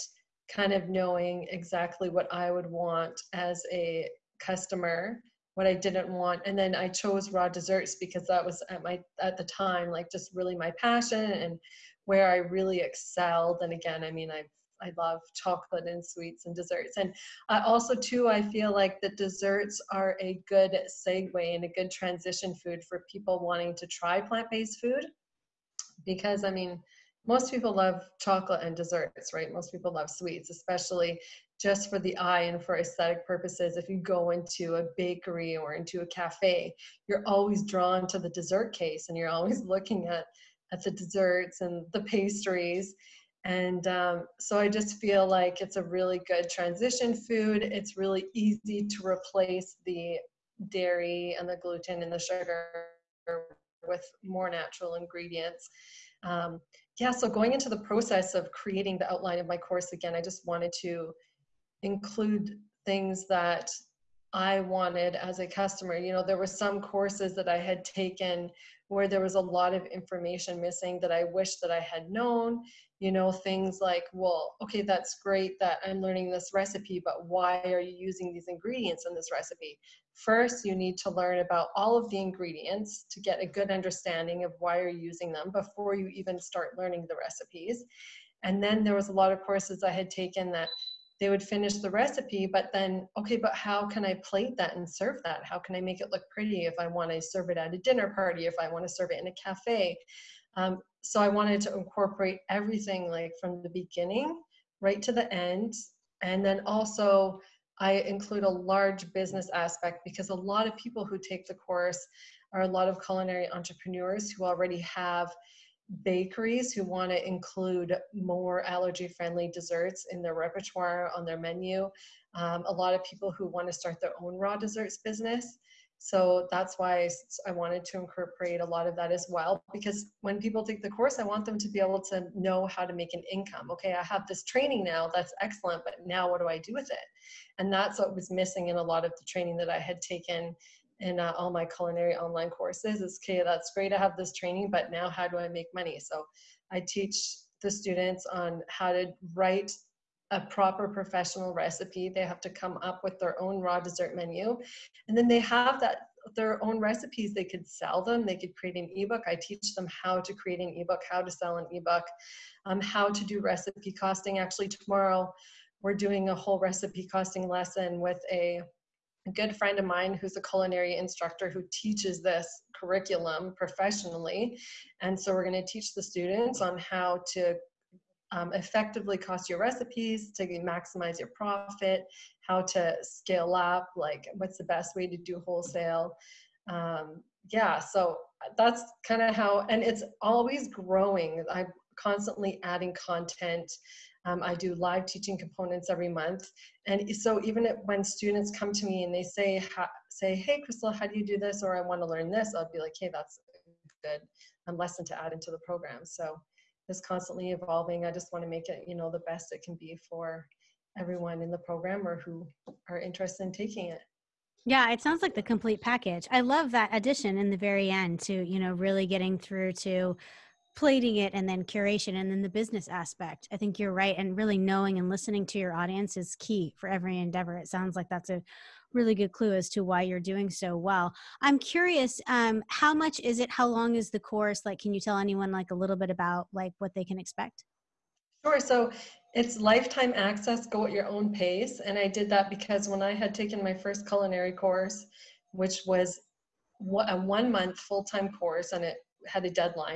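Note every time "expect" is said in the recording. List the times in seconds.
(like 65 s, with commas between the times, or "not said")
237 s.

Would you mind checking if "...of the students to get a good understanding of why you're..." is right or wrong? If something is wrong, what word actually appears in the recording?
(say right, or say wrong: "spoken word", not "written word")
wrong: "ingredients", not "students".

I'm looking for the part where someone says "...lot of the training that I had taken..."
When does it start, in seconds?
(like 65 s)
138 s.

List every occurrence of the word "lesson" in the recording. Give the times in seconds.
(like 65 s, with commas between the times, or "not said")
167 s, 204 s.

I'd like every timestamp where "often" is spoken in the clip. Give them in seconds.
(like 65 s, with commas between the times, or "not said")
not said.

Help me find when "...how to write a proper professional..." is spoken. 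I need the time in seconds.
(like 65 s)
148 s.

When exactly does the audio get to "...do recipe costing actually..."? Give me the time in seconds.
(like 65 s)
163 s.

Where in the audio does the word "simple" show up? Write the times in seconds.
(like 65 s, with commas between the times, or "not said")
not said.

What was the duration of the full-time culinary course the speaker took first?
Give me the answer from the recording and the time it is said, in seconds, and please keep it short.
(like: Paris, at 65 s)
One month, at 247 s.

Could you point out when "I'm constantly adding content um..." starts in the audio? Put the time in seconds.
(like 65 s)
191 s.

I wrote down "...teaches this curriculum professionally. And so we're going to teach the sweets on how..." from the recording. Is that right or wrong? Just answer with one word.
wrong.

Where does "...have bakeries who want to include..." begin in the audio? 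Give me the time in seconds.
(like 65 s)
114 s.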